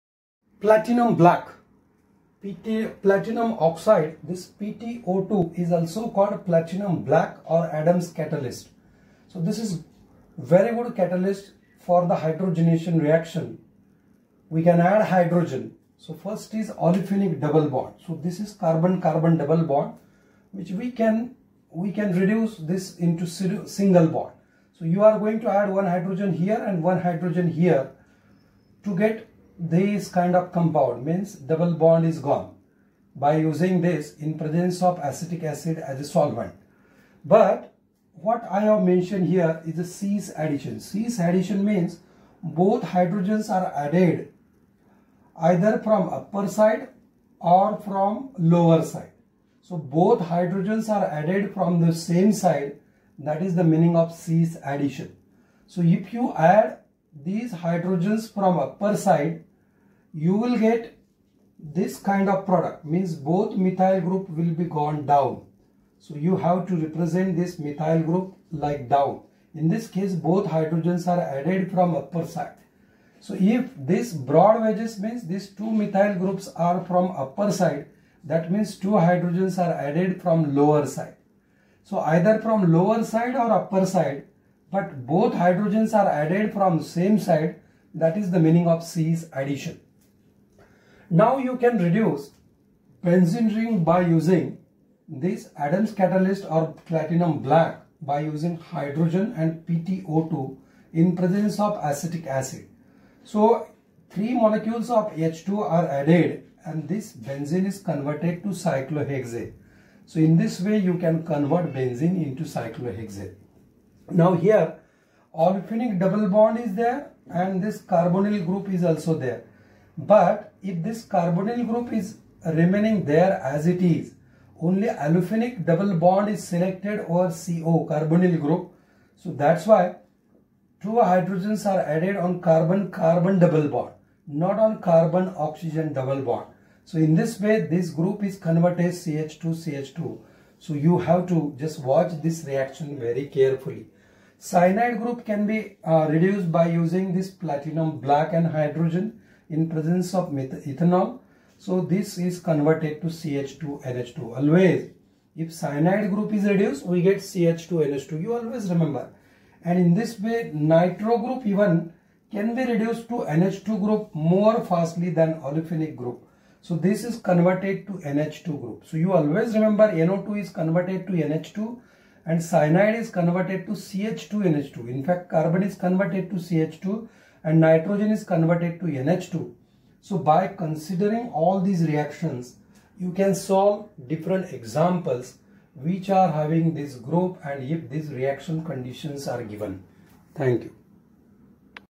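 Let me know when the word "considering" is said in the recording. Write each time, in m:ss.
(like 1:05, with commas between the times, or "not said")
3:00.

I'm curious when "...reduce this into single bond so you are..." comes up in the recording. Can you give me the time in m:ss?
0:22.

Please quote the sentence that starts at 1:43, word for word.
So three molecules of H2 are added and this benzene is converted to cyclohexane.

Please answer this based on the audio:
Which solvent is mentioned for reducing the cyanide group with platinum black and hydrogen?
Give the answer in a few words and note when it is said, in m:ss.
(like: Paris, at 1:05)
ethanol, at 2:30.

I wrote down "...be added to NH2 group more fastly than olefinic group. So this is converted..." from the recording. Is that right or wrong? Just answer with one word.
wrong.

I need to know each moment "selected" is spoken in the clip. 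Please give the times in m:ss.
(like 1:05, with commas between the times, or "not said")
2:06.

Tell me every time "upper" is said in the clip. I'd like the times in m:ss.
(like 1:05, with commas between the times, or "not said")
0:46, 0:58, 1:11, 1:17, 1:23.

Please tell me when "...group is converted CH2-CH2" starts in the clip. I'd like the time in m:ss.
2:17.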